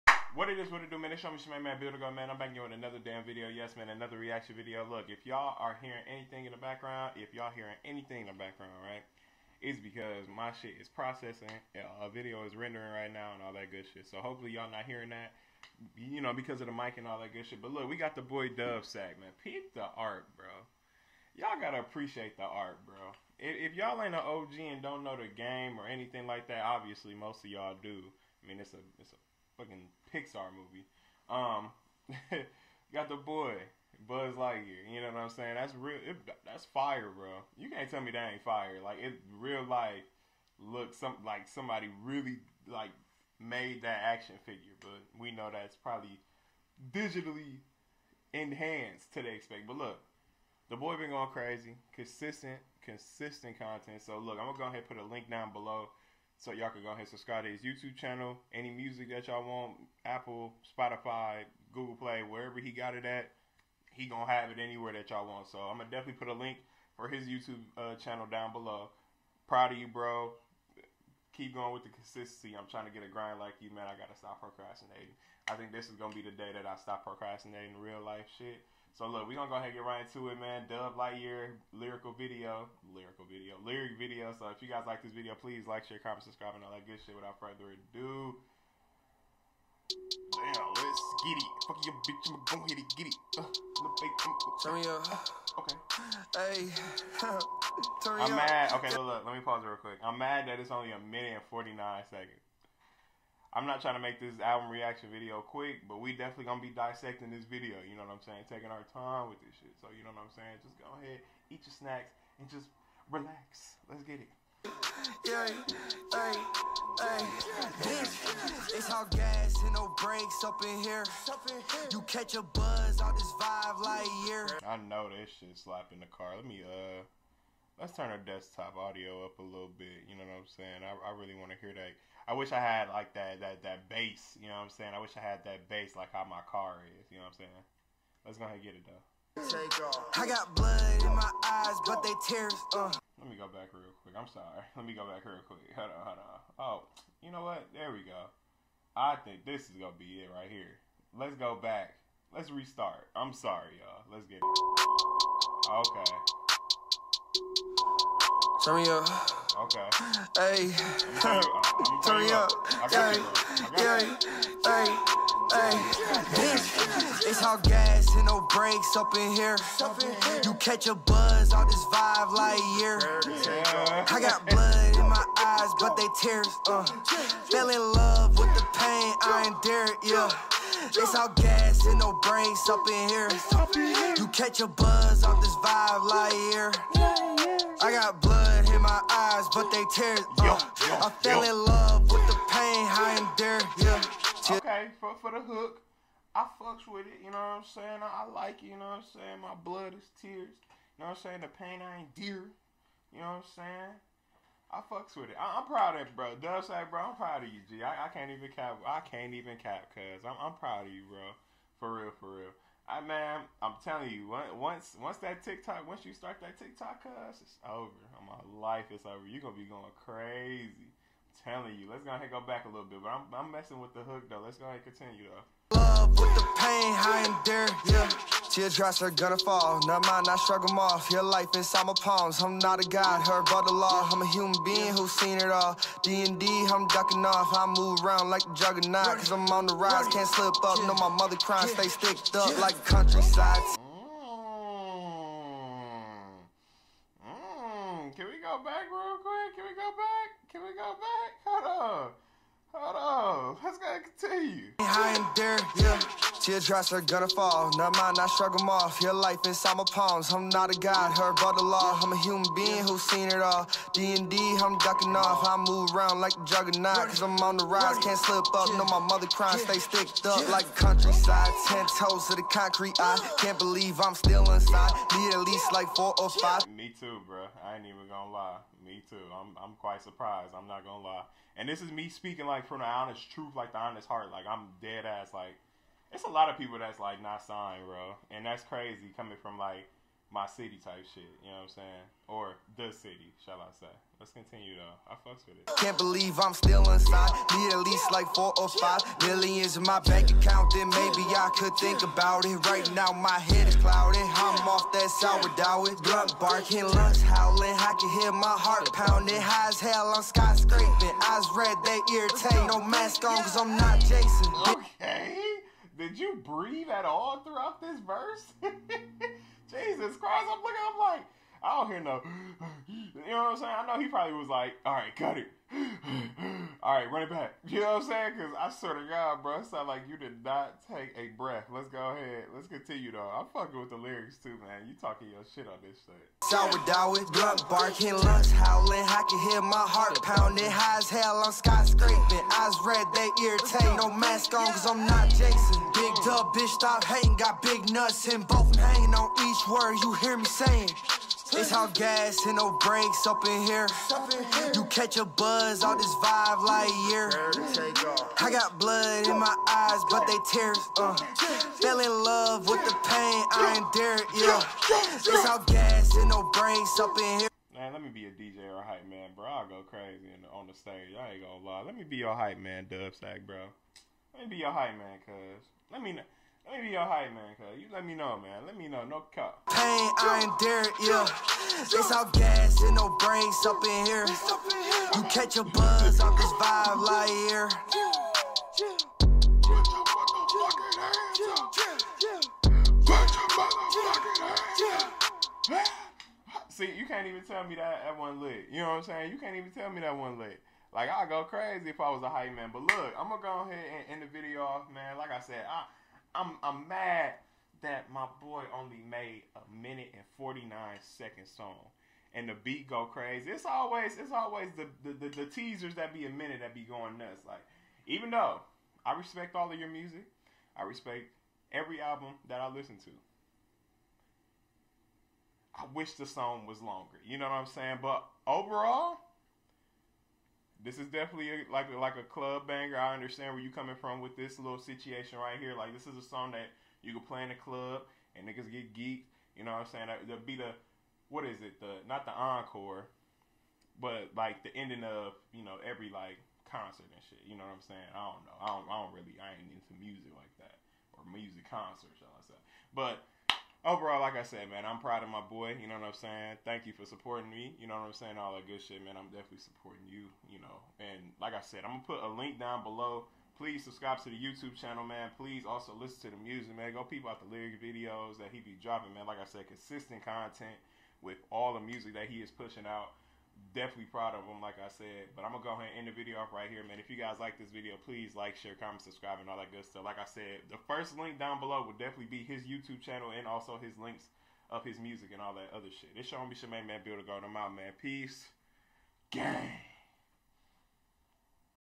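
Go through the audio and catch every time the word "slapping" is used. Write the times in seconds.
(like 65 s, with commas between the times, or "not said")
125 s.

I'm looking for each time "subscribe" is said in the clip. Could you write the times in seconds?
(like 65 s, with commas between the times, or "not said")
57 s, 86 s, 463 s, 479 s.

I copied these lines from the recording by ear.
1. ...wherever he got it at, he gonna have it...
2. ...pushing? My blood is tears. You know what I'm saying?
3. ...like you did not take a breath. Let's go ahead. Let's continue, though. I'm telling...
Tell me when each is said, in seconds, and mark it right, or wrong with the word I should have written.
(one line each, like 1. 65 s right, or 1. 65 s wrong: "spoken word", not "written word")
1. 62 s right
2. 199 s wrong: "saying", not "pushing"
3. 329 s wrong: "fucking", not "telling".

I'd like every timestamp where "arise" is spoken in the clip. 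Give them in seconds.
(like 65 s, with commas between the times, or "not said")
not said.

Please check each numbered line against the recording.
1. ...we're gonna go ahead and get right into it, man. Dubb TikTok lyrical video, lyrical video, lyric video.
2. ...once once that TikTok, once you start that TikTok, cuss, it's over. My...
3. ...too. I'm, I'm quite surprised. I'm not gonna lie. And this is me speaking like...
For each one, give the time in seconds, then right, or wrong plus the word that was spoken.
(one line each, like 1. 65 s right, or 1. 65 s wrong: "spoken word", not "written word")
1. 79 s wrong: "Lightyear", not "TikTok"
2. 214 s right
3. 279 s right.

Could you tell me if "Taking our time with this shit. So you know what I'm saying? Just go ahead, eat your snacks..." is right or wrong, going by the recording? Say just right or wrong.
right.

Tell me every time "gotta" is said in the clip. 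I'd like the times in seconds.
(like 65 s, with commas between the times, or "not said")
21 s, 73 s.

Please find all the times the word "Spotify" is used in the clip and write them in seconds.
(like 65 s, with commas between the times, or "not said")
60 s.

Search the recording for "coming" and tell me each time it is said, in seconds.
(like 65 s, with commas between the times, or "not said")
289 s, 433 s.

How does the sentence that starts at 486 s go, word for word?
It's your homie Shemaine Man Build a garden, am out, man.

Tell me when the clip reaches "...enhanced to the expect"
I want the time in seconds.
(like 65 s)
48 s.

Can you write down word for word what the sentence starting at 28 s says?
I mean, it's a it's a fucking Pixar movie.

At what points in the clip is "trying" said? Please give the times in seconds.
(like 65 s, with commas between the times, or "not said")
72 s, 103 s.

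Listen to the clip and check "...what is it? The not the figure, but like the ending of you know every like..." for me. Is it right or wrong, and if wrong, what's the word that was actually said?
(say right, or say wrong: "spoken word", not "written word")
wrong: "encore", not "figure".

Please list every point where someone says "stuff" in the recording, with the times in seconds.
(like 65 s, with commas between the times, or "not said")
452 s, 479 s.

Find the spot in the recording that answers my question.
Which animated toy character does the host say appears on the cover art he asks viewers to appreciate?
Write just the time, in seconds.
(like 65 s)
34 s.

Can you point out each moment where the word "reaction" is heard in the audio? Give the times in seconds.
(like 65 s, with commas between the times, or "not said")
4 s, 104 s.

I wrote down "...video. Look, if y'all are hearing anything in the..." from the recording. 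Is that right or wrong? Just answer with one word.
right.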